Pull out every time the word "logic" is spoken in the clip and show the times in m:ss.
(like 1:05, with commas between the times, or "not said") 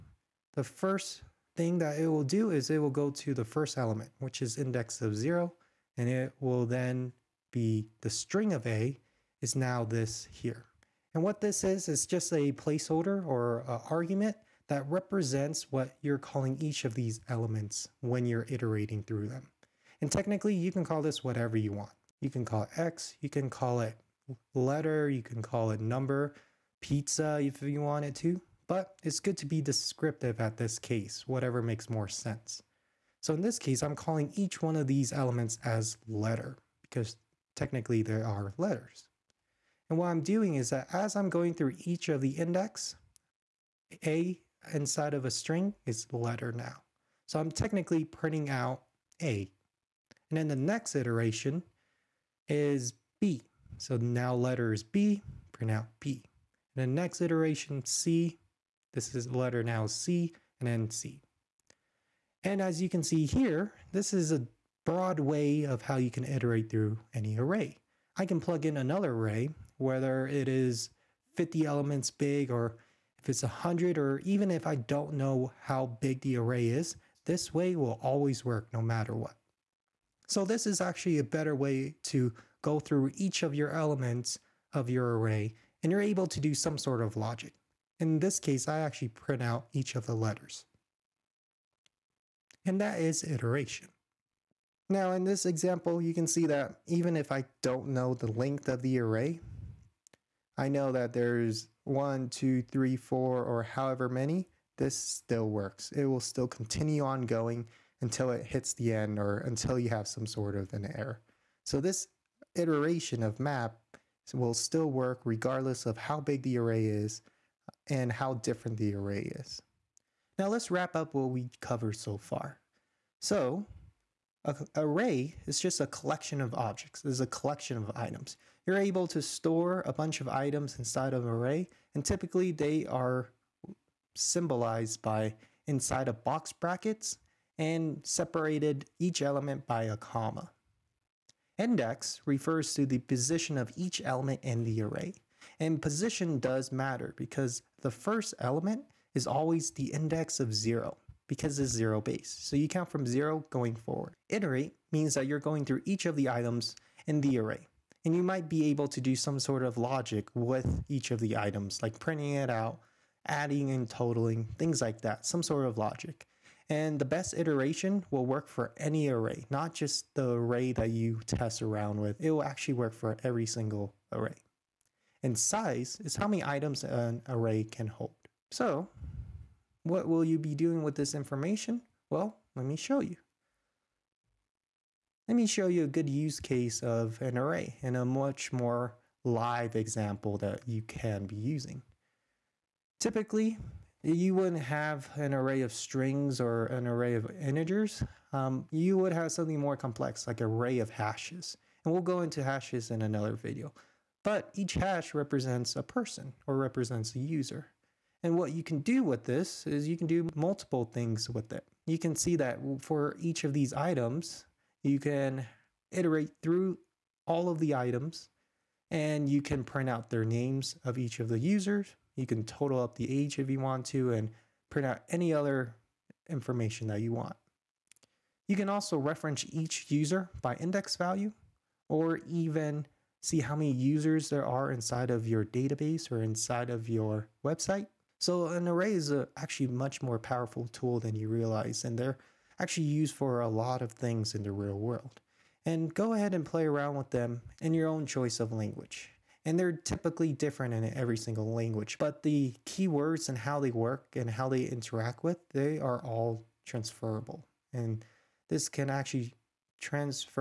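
1:27, 2:39, 2:45.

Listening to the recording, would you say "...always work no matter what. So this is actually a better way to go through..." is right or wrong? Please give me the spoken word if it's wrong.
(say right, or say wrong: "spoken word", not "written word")
right.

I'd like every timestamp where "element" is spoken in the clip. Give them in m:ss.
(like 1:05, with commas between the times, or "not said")
0:03, 0:17, 0:35, 1:11, 1:23, 2:19, 2:24, 2:28.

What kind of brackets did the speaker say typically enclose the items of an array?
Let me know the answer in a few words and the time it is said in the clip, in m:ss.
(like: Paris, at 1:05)
box brackets, at 2:16.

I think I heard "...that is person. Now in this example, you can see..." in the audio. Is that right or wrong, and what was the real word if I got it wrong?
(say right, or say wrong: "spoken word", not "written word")
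wrong: "iteration", not "person".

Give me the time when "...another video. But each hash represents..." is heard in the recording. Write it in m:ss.
3:23.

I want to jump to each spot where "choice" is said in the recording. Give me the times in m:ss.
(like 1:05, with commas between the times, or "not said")
4:08.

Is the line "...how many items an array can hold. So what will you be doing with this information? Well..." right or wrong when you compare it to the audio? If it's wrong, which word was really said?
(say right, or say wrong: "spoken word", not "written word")
right.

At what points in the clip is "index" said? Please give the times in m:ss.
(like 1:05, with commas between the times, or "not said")
0:04, 0:42, 2:21, 2:29, 3:50.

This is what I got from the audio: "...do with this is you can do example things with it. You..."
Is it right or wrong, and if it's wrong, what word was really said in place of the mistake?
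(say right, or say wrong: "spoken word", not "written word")
wrong: "multiple", not "example".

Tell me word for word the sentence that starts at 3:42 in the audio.
You can total up the age if you want to and print out any other information that you want.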